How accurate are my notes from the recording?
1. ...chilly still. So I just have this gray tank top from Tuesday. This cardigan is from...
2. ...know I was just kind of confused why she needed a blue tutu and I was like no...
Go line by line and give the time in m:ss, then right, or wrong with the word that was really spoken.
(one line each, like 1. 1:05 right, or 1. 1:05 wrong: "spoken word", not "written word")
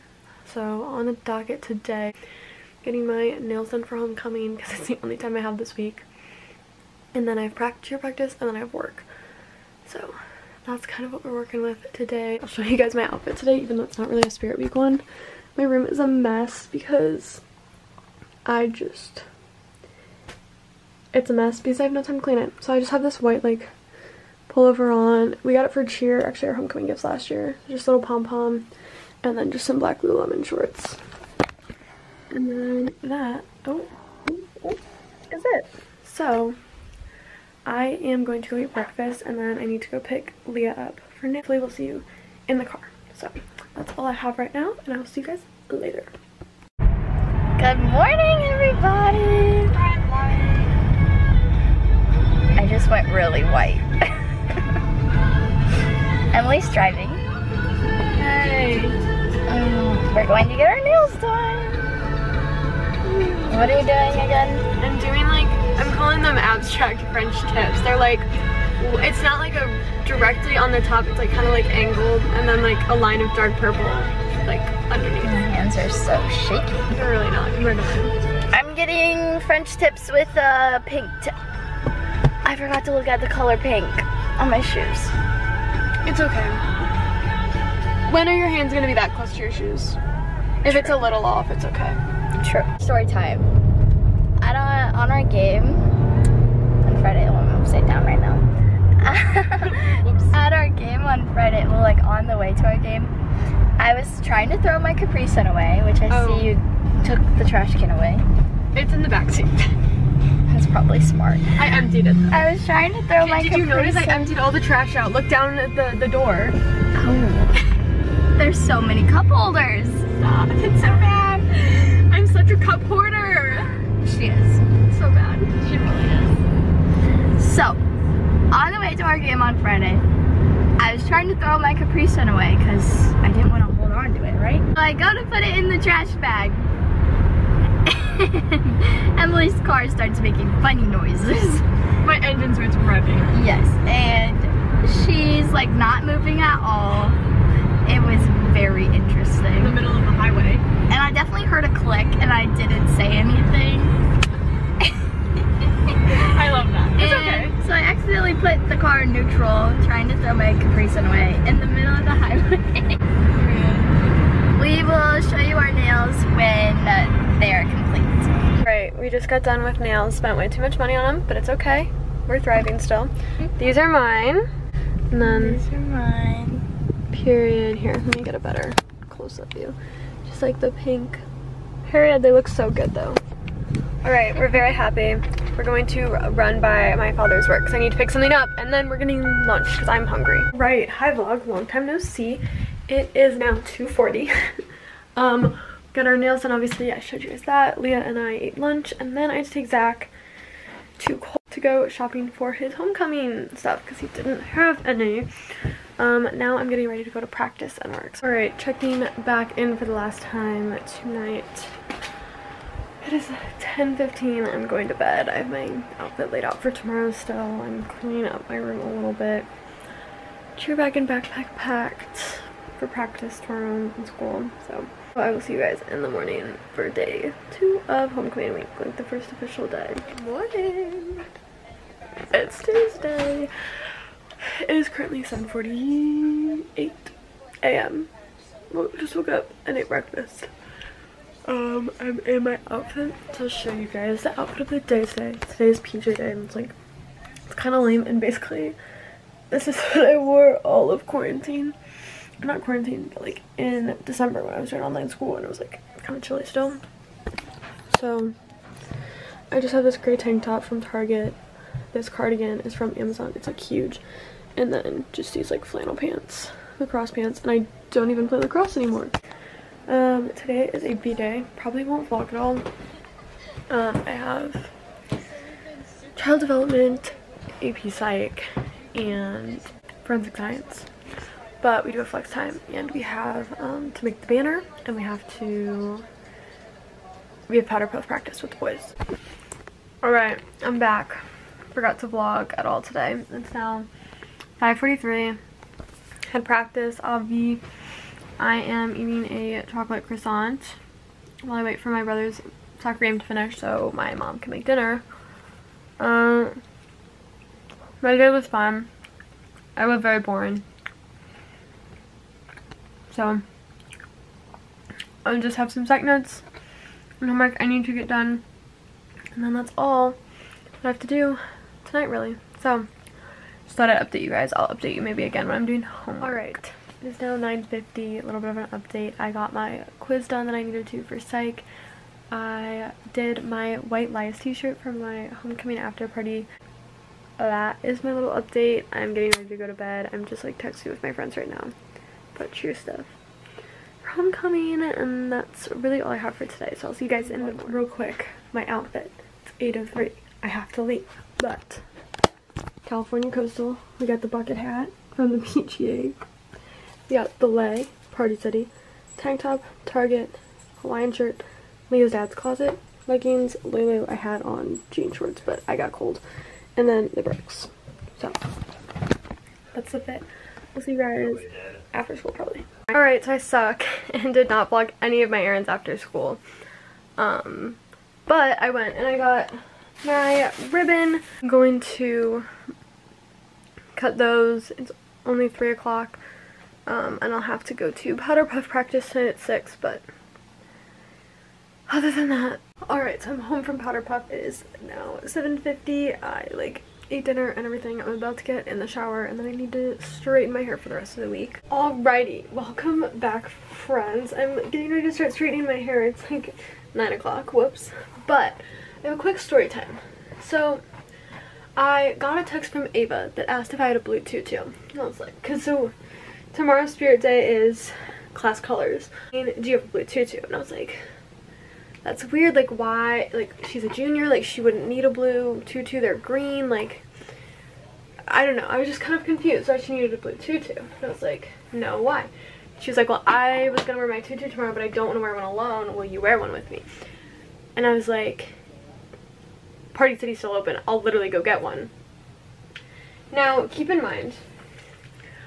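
1. 4:16 wrong: "Target", not "Tuesday"
2. 7:08 right.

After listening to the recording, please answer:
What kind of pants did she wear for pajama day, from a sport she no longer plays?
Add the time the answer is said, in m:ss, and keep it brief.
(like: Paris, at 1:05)
lacrosse pants, at 4:26.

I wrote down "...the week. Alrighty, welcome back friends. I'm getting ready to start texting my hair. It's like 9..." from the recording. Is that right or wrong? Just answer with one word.
wrong.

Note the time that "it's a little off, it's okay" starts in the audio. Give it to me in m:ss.
1:30.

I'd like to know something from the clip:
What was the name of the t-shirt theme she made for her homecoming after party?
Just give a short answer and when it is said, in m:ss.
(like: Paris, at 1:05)
White Lies, at 5:33.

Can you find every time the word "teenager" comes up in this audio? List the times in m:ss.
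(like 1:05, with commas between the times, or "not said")
not said.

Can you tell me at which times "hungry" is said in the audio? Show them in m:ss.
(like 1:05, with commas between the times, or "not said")
3:10.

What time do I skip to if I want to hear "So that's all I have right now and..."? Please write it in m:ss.
0:43.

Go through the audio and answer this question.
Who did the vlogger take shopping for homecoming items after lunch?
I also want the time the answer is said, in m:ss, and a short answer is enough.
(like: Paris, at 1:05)
Zach, at 3:19.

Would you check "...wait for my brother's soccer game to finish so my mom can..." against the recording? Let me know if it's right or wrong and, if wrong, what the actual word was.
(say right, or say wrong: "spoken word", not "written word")
right.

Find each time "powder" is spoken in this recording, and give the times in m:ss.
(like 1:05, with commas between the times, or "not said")
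4:47, 6:28, 6:33.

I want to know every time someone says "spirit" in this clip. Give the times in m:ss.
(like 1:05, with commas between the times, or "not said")
0:14, 6:56.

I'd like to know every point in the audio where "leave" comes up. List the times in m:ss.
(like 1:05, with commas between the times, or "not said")
5:50.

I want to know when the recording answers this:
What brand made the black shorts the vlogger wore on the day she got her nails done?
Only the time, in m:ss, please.
0:30.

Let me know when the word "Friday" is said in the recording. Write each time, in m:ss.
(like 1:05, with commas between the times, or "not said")
1:37, 1:41, 2:09.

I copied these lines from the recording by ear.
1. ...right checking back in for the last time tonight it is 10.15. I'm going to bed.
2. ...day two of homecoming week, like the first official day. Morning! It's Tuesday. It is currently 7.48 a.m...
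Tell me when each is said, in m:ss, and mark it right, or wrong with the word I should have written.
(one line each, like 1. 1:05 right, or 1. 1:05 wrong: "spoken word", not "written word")
1. 3:28 right
2. 3:46 right.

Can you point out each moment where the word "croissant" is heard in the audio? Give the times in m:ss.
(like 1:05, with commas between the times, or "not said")
5:00.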